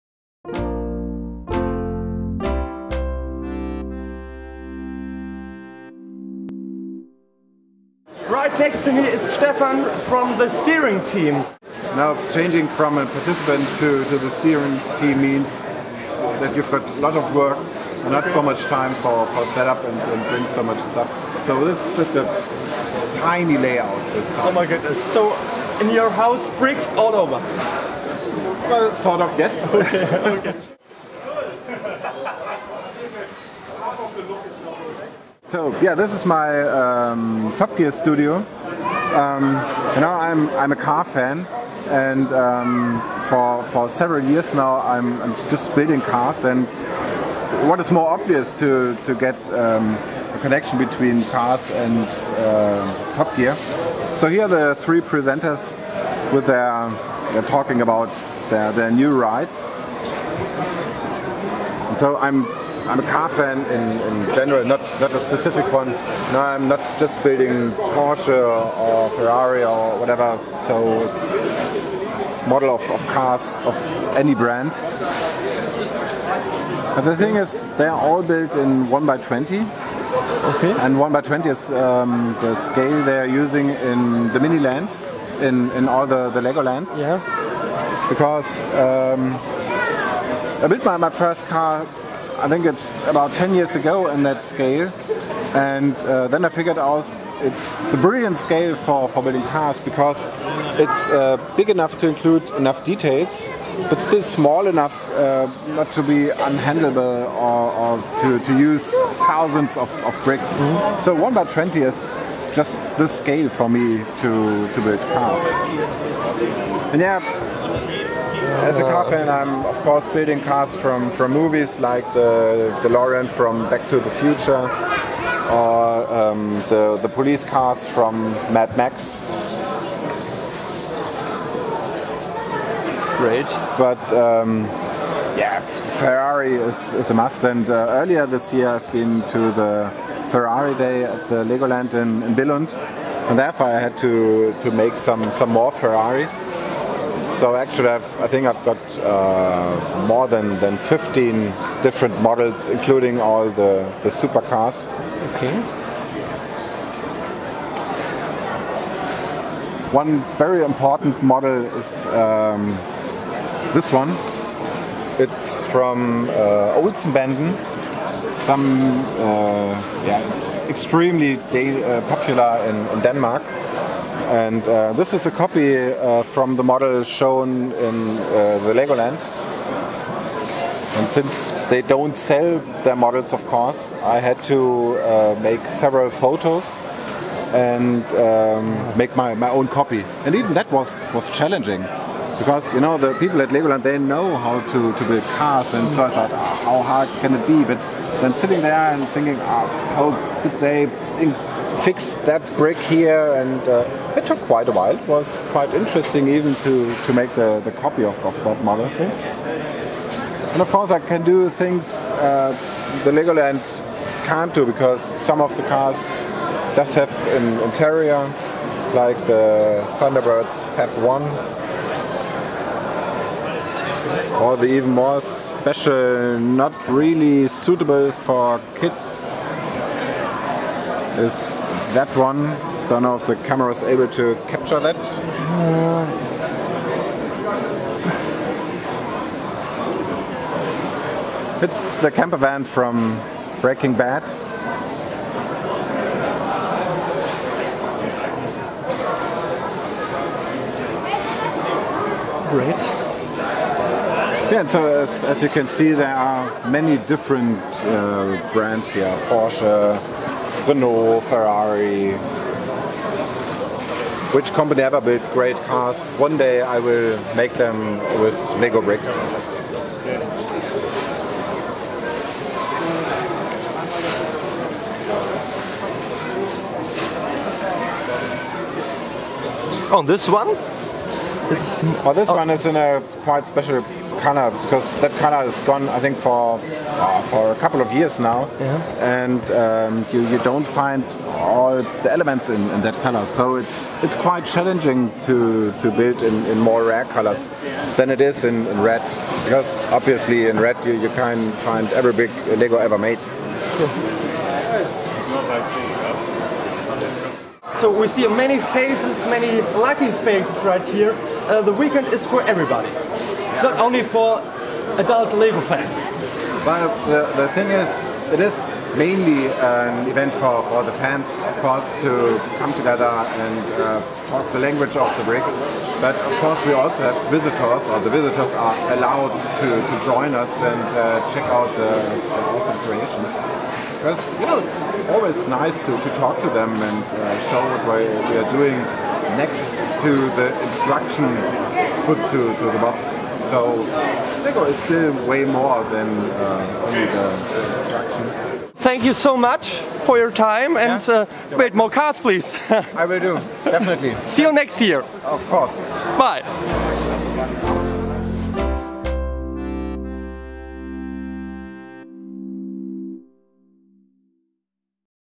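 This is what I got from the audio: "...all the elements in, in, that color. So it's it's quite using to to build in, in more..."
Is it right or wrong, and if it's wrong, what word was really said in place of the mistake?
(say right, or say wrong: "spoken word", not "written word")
wrong: "challenging", not "using".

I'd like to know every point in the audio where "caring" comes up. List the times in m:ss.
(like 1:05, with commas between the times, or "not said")
not said.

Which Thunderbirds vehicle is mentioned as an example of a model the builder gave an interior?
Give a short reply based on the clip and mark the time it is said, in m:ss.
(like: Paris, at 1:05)
Fab 1, at 3:40.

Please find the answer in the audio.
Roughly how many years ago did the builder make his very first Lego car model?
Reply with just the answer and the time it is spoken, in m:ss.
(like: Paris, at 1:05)
10 years, at 1:33.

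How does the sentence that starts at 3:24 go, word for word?
It was quite interesting even to, to make the, the copy of, of that model.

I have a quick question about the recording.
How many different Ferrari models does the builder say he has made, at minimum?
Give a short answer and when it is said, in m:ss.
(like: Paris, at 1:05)
More than 15, at 2:30.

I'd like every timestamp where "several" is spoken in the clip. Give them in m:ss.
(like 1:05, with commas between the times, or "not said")
0:43, 3:05.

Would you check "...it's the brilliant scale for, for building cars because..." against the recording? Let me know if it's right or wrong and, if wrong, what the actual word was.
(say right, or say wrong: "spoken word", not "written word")
right.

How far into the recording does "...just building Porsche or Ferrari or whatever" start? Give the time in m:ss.
1:06.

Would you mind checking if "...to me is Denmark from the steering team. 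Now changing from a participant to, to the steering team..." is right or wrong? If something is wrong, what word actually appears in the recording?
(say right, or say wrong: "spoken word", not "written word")
wrong: "Stephan", not "Denmark".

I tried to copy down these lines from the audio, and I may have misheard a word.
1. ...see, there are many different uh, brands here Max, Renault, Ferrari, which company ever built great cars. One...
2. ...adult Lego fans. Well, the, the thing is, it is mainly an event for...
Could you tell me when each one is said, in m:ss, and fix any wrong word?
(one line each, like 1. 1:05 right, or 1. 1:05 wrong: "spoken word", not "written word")
1. 4:15 wrong: "Porsche", not "Max"
2. 5:14 right.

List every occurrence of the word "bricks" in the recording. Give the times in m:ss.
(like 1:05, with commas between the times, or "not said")
0:26, 1:50, 3:22, 4:28, 5:25.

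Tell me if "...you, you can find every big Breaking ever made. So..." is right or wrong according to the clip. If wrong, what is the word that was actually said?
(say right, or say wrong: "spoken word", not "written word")
wrong: "Lego", not "Breaking".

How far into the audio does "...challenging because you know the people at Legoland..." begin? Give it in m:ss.
3:11.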